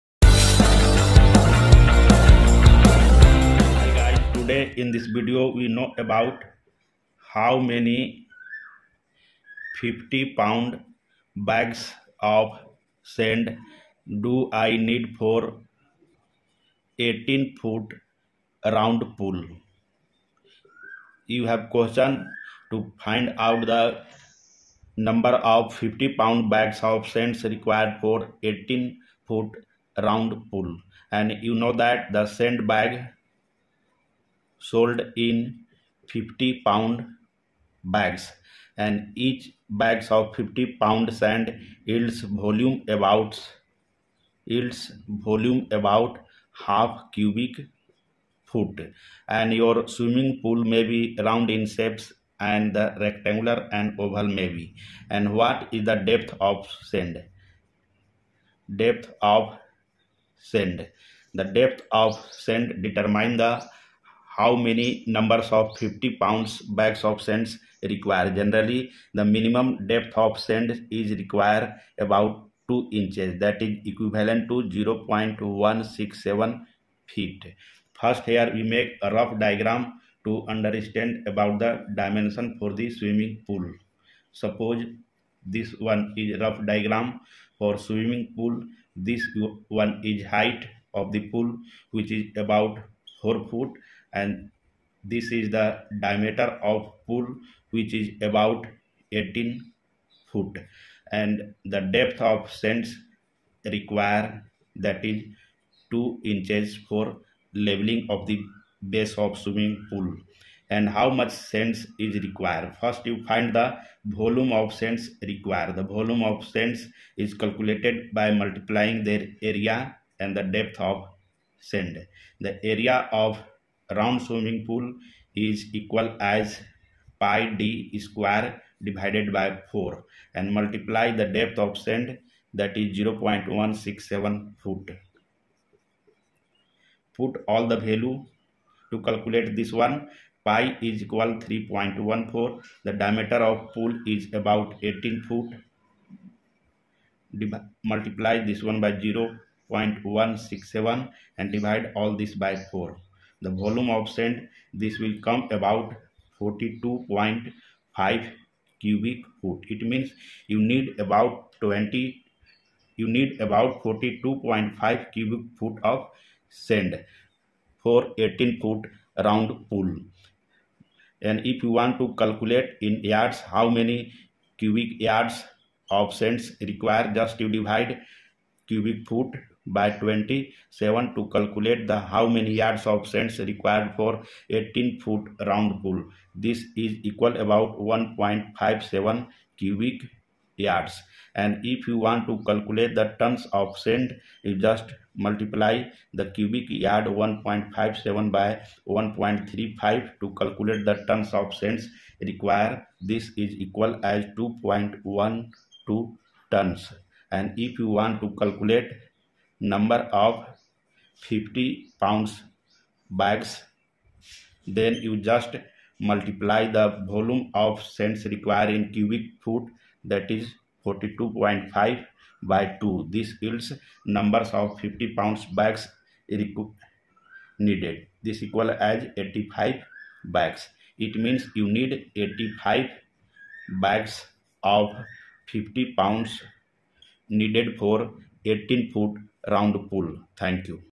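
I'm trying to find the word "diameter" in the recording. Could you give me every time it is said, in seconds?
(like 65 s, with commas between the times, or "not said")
96 s, 142 s.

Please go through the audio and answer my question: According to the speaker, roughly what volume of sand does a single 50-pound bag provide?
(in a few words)
half cubic foot.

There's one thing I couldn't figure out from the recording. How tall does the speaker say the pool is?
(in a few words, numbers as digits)
4 foot.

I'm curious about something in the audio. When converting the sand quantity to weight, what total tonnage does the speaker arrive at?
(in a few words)
2.12 tons.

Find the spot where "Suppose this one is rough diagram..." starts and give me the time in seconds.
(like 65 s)
84 s.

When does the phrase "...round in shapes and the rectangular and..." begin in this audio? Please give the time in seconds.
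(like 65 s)
51 s.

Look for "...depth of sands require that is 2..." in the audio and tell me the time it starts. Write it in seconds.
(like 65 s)
101 s.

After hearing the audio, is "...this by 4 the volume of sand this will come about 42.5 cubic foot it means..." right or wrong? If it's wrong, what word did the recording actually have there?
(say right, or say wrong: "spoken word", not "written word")
right.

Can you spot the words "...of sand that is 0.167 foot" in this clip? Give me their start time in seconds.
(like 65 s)
131 s.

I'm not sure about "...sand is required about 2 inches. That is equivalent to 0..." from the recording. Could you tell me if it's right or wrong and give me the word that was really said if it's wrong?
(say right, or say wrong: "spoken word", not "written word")
right.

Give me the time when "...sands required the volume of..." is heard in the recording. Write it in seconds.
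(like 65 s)
114 s.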